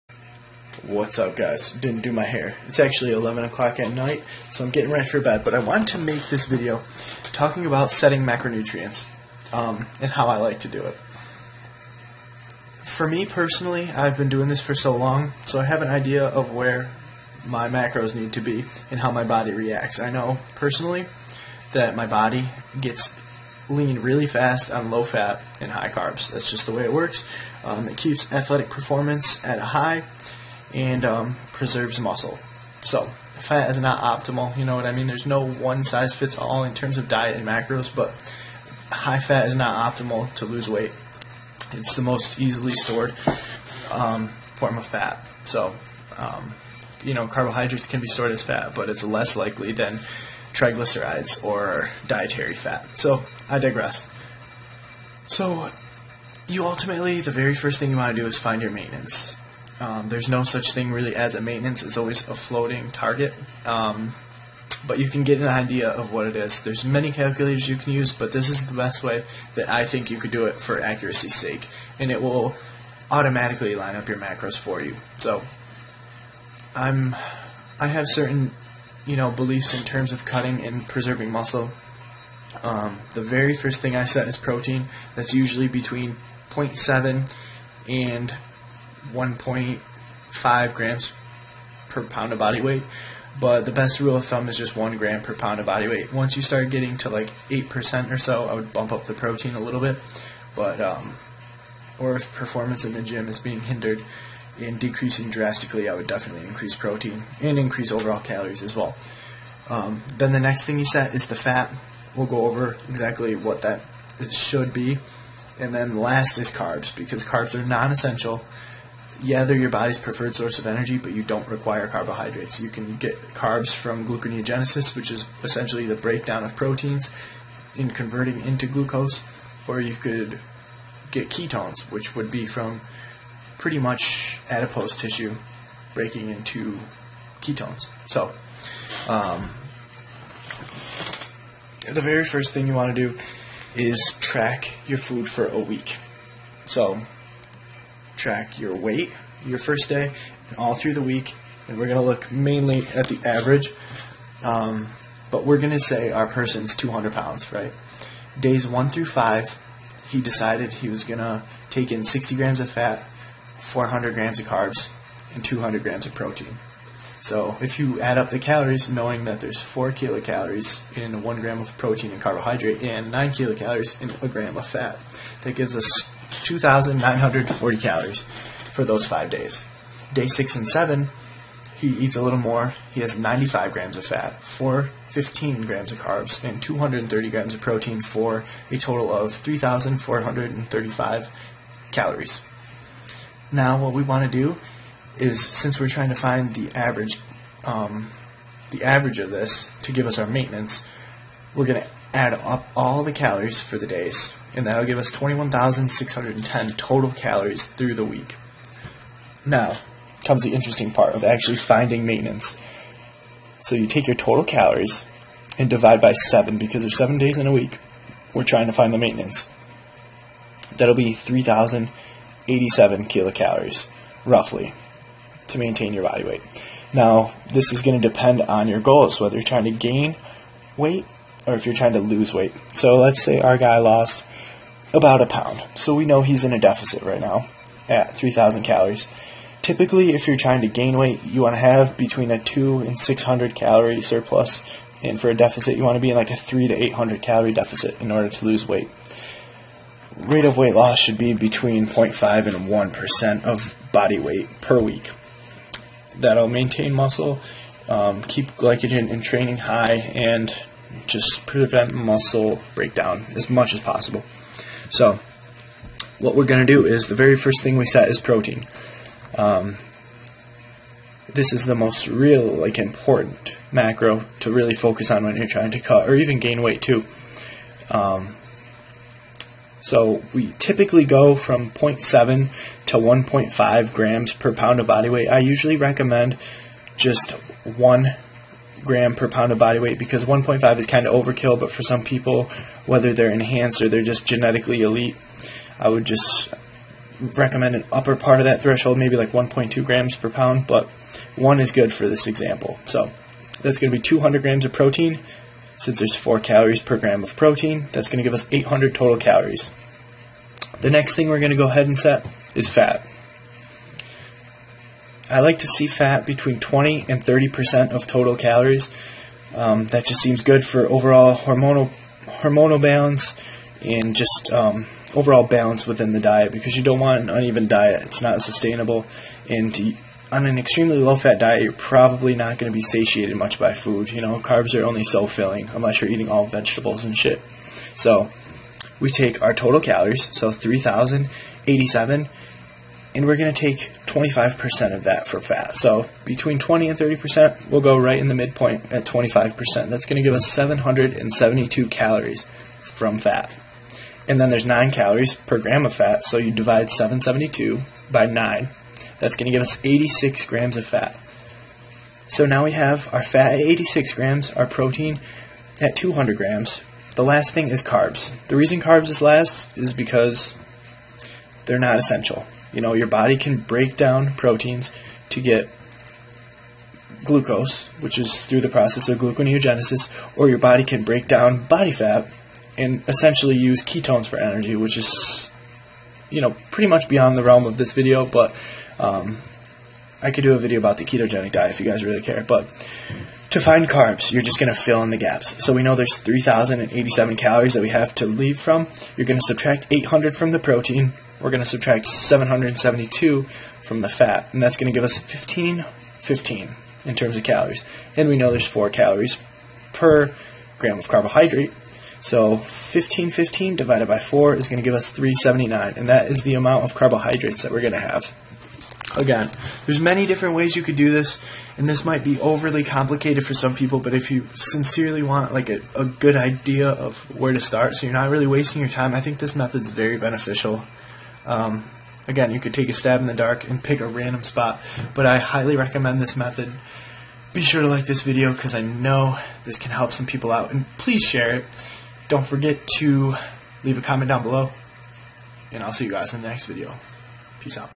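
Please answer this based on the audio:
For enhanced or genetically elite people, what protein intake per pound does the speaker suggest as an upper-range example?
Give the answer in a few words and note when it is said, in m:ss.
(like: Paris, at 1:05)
1.2 grams per pound, at 4:59.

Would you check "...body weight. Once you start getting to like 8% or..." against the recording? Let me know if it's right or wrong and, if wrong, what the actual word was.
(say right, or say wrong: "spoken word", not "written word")
right.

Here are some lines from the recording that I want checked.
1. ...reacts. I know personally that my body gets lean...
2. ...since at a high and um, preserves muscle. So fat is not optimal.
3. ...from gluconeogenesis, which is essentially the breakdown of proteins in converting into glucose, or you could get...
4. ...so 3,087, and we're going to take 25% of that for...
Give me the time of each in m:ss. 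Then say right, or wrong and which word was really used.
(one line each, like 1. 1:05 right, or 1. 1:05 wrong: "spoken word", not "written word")
1. 0:19 right
2. 0:28 wrong: "performance", not "since"
3. 2:03 right
4. 5:40 right.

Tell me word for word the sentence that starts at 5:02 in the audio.
So that's going to be 200 grams of protein.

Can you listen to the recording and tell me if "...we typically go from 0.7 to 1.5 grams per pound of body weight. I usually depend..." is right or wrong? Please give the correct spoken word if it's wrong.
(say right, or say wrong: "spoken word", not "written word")
wrong: "recommend", not "depend".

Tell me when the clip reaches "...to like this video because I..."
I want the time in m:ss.
7:17.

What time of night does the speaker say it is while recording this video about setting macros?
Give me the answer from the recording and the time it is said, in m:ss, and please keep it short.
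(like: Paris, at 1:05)
11 o'clock, at 0:03.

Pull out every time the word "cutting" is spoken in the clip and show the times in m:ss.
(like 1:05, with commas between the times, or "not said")
1:20.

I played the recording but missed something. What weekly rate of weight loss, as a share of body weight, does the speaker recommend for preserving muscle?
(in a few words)
0.5 to 1%.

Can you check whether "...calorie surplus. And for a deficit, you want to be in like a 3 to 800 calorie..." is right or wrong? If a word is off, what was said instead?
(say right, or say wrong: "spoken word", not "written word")
right.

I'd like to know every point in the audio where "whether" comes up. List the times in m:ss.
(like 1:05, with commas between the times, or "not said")
3:49, 4:52.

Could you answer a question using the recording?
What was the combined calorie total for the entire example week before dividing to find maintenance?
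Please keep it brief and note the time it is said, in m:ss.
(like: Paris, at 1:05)
21,610, at 3:25.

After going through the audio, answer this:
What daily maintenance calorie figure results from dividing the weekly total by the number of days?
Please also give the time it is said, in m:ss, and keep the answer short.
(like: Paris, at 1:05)
3,087, at 3:41.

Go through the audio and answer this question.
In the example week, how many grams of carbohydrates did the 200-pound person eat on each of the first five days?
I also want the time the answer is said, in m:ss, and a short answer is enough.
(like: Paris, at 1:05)
400 grams, at 2:43.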